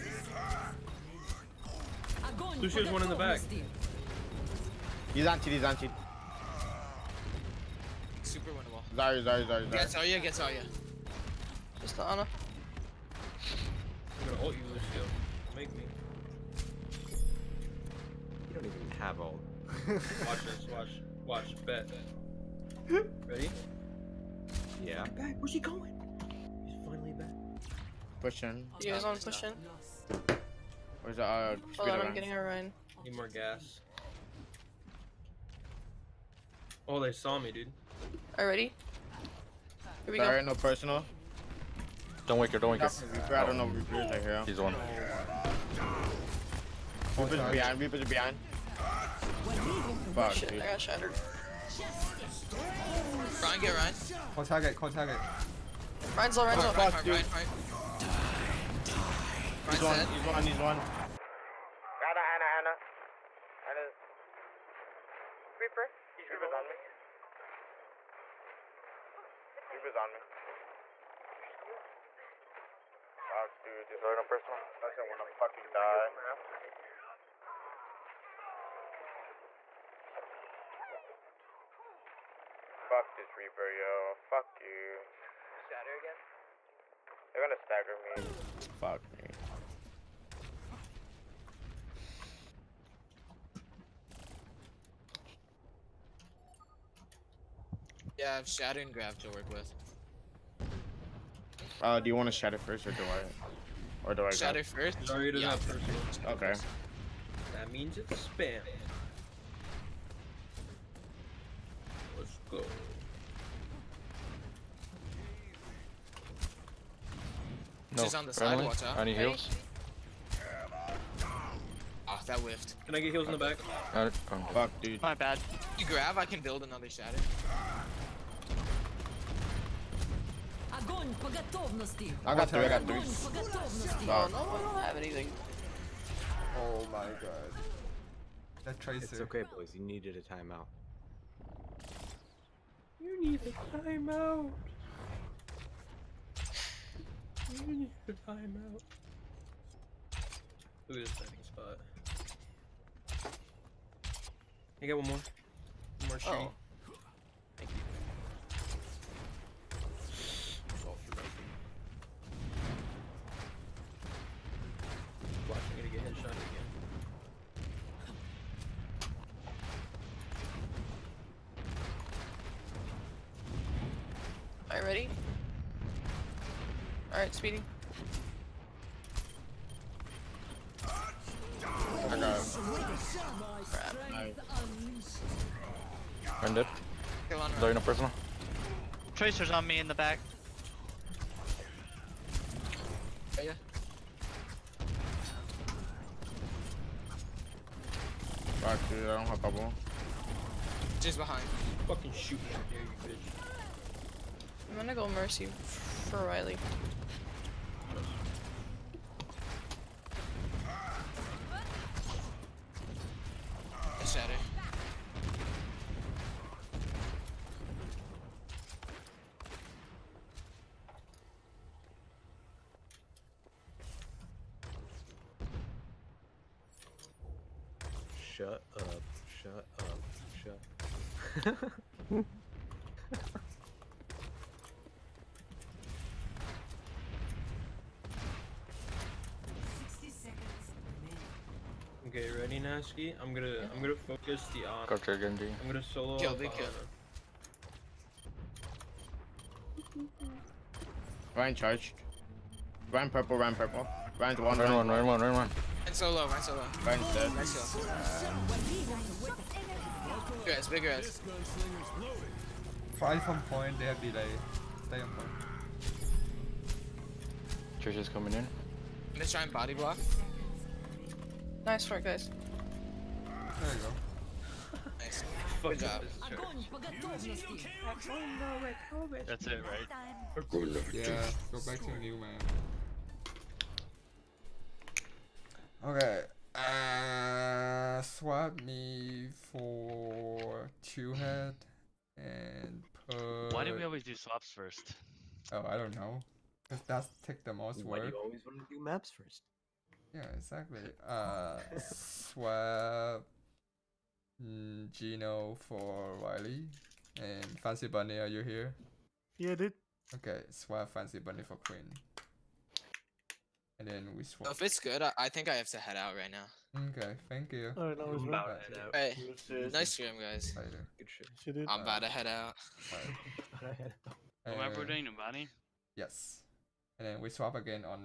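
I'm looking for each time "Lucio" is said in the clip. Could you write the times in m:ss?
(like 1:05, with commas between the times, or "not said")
0:02, 0:14.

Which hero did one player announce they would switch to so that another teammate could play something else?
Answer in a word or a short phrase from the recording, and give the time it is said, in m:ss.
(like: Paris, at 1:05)
Mercy, at 3:24.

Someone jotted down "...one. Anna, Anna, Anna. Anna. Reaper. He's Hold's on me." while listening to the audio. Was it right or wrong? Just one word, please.
wrong.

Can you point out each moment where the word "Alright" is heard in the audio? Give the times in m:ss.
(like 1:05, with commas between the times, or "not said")
2:57, 5:17.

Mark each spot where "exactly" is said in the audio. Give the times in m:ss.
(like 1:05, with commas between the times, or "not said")
5:00.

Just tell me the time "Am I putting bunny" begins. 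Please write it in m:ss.
5:24.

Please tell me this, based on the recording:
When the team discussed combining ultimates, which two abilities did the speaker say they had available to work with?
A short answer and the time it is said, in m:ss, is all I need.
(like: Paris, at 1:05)
Shatter and Grav, at 1:38.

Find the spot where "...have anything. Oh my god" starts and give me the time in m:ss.
2:14.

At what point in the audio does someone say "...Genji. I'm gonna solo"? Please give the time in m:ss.
4:05.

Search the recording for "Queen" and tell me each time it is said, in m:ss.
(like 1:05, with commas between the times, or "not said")
5:11.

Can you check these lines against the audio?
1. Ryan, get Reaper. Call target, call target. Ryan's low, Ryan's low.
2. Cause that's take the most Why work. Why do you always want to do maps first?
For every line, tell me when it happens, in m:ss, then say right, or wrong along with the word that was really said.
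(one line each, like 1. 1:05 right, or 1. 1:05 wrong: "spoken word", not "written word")
1. 0:53 wrong: "Ryan", not "Reaper"
2. 4:56 right.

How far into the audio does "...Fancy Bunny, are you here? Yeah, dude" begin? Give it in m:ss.
5:07.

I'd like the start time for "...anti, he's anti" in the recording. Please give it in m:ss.
0:05.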